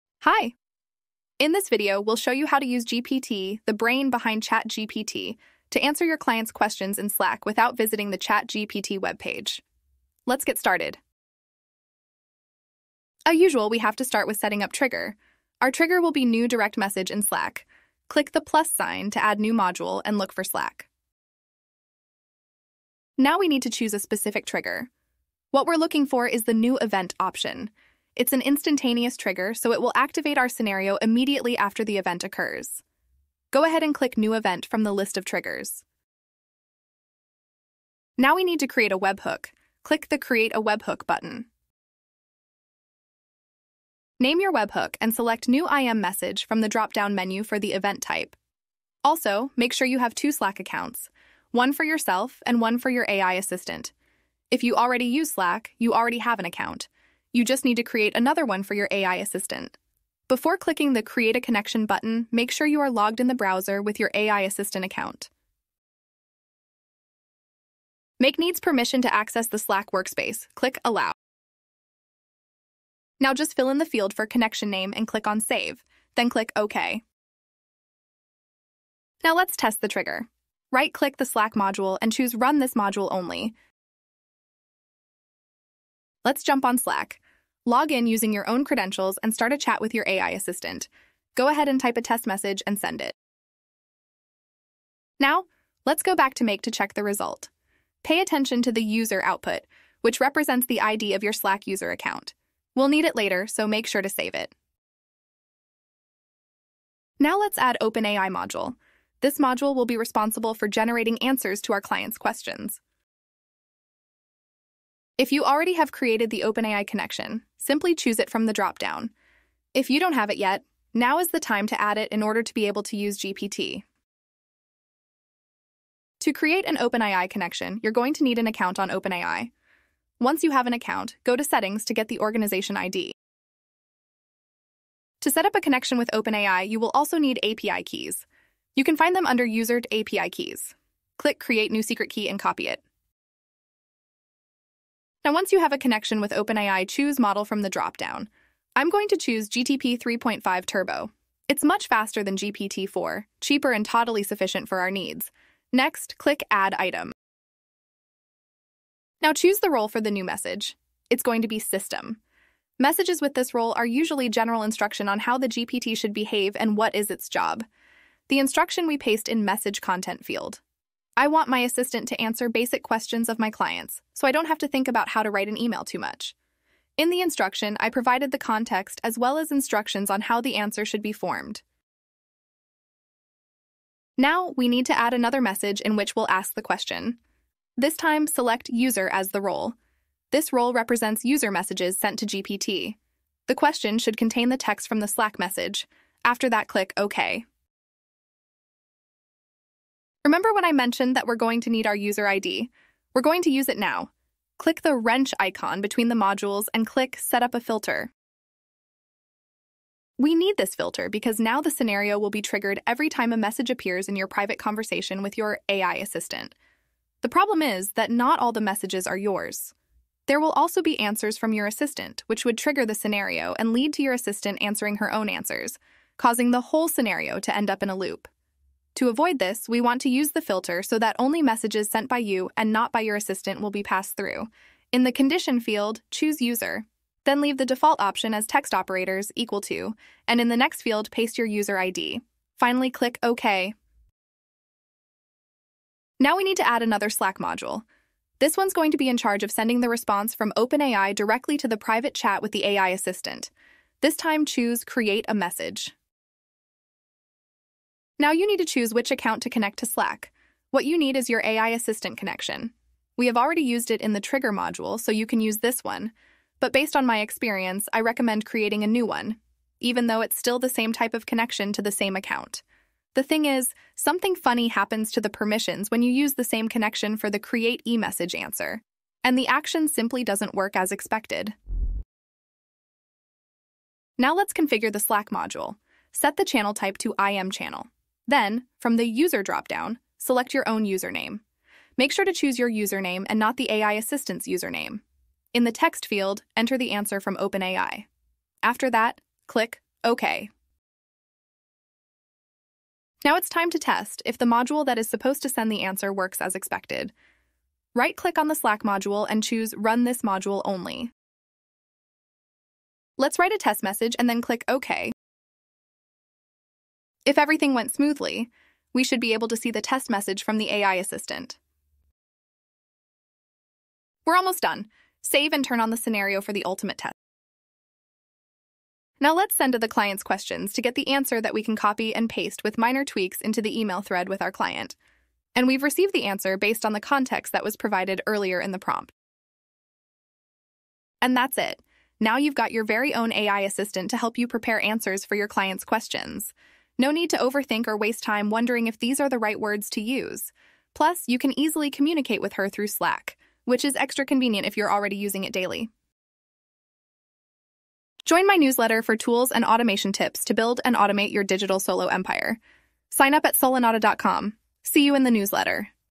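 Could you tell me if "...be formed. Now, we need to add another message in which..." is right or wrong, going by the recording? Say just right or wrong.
right.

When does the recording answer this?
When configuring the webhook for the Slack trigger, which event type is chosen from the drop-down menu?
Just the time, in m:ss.
0:45.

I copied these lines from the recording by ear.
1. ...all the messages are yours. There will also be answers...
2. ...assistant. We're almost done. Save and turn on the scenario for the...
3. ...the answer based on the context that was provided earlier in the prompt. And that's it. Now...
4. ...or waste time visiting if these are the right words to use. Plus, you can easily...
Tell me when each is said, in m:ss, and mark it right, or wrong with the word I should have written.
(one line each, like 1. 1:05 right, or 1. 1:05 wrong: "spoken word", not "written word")
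1. 3:38 right
2. 5:20 right
3. 5:36 right
4. 5:47 wrong: "wondering", not "visiting".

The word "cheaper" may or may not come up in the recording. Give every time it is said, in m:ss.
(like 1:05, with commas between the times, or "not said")
2:33.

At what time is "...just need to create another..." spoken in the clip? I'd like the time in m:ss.
0:57.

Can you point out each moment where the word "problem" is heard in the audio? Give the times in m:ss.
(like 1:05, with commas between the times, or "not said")
3:37.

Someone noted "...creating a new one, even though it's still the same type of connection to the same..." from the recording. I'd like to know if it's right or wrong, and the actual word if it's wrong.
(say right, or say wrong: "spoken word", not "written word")
right.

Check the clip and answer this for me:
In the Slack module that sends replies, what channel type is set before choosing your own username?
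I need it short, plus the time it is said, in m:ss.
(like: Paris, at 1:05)
IM channel, at 4:47.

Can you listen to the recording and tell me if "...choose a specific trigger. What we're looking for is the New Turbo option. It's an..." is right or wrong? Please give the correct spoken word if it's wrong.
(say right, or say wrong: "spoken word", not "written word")
wrong: "Event", not "Turbo".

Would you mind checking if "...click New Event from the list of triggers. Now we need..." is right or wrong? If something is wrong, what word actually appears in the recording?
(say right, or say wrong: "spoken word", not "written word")
right.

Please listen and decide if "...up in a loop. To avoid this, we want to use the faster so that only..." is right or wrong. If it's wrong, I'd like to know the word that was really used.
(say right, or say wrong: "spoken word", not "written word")
wrong: "filter", not "faster".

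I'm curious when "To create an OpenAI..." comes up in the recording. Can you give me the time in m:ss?
2:06.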